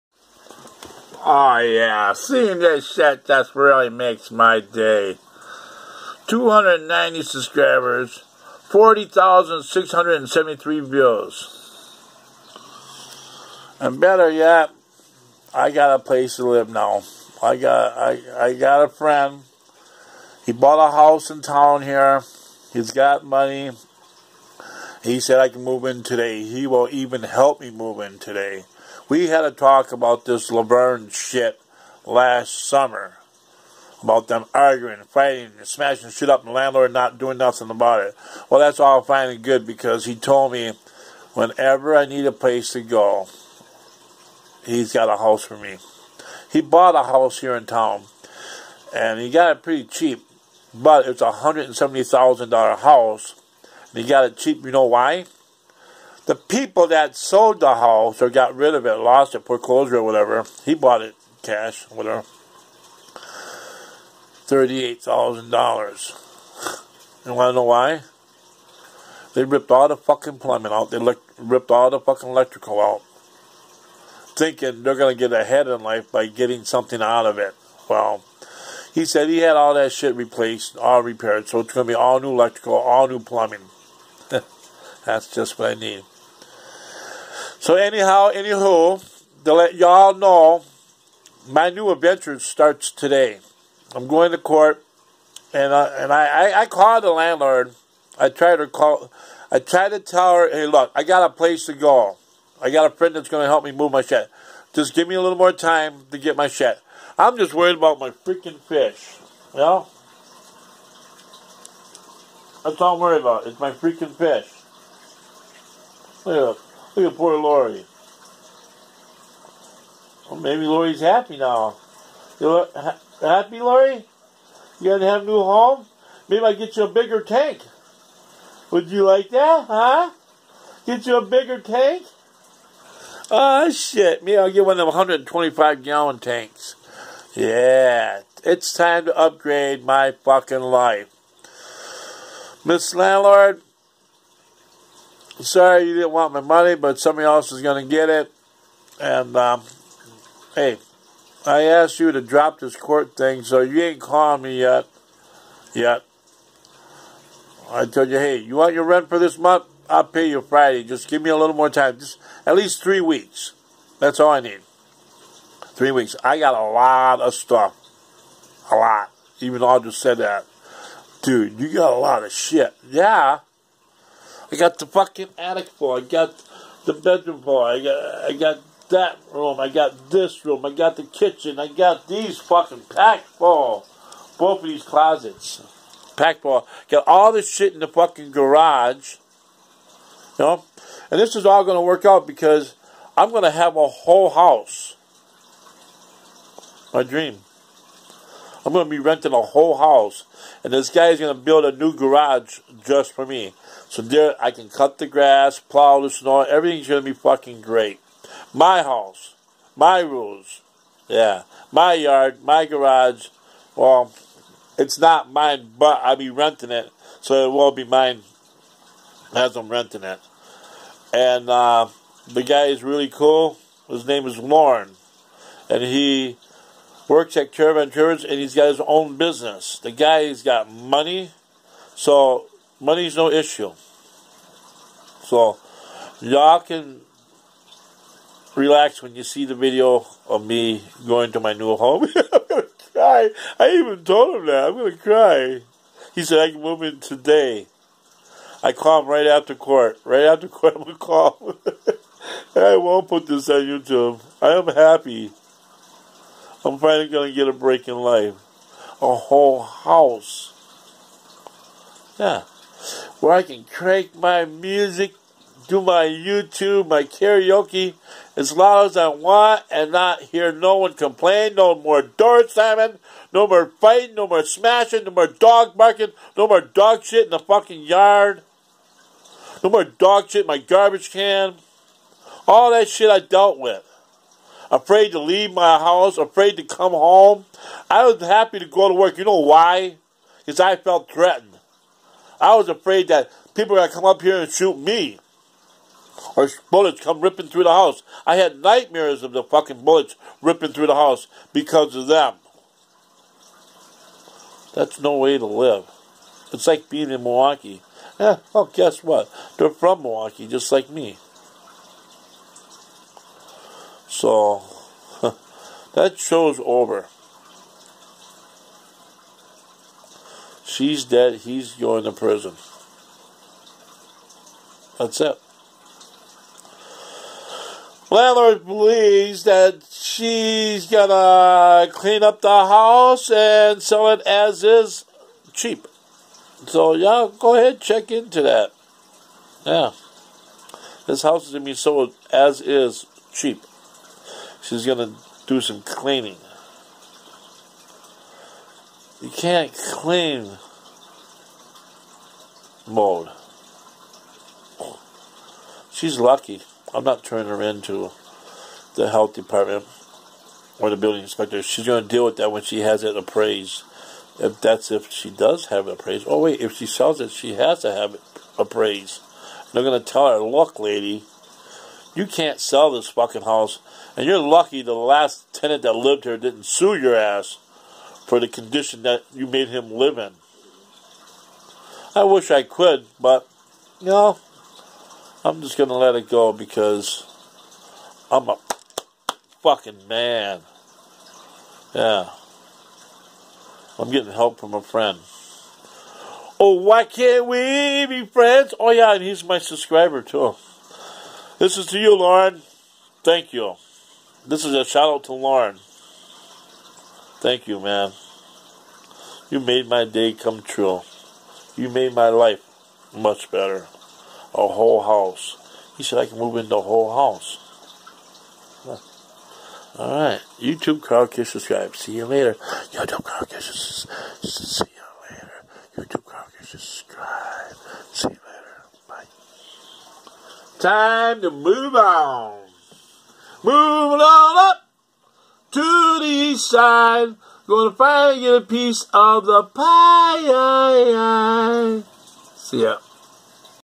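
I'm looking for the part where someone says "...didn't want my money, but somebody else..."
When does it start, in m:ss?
2:25.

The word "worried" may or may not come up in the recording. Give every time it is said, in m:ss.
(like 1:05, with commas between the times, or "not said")
1:47, 1:53.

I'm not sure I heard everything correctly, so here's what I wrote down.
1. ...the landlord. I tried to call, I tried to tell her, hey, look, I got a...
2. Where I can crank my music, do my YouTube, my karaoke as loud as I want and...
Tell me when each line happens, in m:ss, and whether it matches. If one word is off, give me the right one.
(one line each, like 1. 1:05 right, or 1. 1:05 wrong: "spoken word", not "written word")
1. 1:37 right
2. 4:23 right.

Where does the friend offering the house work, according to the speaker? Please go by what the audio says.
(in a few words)
Caravan Tours.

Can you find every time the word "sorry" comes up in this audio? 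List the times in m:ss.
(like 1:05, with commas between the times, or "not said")
2:25.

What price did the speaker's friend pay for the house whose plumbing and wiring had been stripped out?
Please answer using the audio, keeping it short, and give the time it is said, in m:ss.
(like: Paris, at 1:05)
$38,000, at 1:04.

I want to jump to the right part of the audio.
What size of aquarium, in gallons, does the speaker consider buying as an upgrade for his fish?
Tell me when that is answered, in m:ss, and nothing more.
2:14.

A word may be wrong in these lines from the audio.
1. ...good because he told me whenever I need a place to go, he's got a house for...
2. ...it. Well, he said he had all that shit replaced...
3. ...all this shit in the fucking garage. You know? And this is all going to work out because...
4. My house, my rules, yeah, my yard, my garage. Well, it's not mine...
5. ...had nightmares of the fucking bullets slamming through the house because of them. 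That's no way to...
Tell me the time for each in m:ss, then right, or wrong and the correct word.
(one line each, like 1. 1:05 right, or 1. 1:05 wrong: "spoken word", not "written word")
1. 0:39 right
2. 1:17 right
3. 3:07 right
4. 3:28 right
5. 4:58 wrong: "ripping", not "slamming".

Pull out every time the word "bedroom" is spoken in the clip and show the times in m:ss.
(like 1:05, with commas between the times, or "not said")
2:56.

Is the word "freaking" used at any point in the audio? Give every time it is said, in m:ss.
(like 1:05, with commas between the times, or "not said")
1:48, 1:53.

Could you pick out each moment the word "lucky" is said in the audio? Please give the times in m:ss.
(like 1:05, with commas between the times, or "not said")
5:56, 6:14.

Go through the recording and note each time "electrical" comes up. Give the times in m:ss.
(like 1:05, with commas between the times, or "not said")
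1:12, 1:22.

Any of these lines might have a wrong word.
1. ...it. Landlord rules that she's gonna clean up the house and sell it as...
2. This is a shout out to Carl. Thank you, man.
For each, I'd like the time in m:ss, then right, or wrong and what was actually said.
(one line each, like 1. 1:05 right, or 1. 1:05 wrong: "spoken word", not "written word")
1. 5:25 wrong: "believes", not "rules"
2. 6:44 wrong: "Loren", not "Carl".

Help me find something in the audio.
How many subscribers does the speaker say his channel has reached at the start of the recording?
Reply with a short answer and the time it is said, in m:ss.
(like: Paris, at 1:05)
290, at 0:06.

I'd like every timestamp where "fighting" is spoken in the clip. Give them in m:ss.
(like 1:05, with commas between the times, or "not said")
0:35, 4:33.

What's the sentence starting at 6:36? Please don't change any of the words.
Oh, why can't we be friends?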